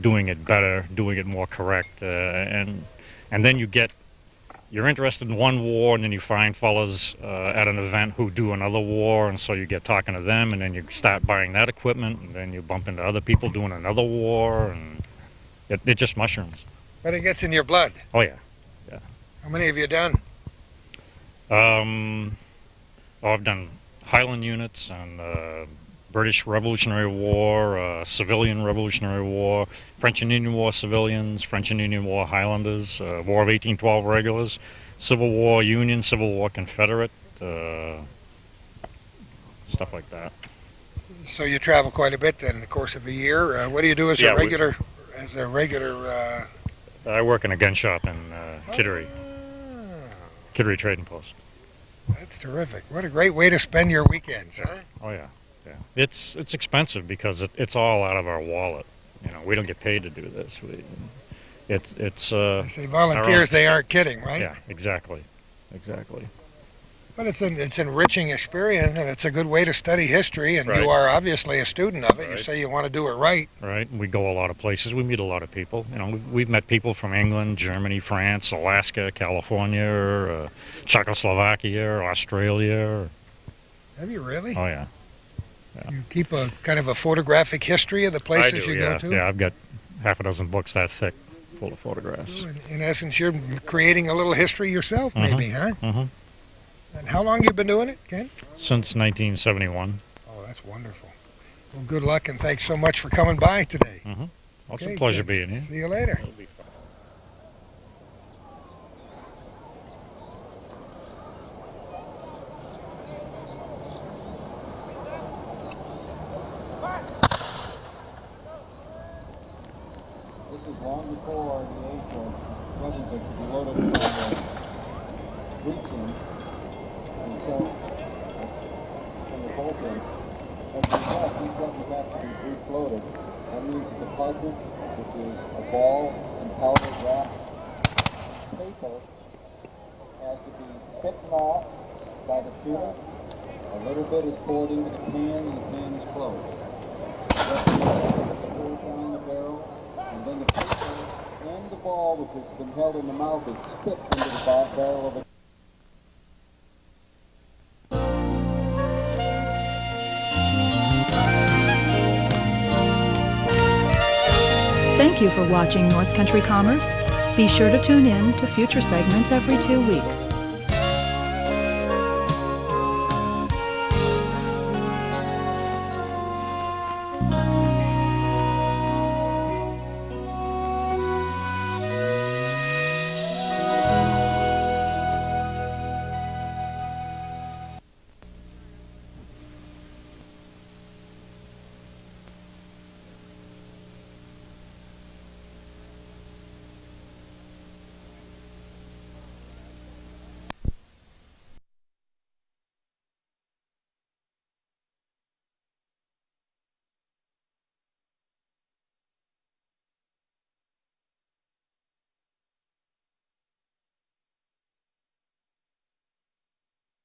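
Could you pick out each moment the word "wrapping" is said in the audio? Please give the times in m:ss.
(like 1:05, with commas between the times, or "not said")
not said.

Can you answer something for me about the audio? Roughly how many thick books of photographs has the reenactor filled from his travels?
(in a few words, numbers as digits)
half a dozen.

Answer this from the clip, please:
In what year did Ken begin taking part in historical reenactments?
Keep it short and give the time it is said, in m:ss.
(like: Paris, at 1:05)
1971, at 1:38.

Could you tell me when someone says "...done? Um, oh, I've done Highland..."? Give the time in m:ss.
0:19.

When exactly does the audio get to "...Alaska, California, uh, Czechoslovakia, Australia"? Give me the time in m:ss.
1:18.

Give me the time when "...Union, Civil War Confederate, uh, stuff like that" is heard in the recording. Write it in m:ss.
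0:35.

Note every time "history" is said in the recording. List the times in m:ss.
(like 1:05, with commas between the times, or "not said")
1:10, 1:27, 1:34.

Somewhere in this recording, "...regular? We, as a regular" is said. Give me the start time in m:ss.
0:44.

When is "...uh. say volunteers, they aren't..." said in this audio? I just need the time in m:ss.
1:02.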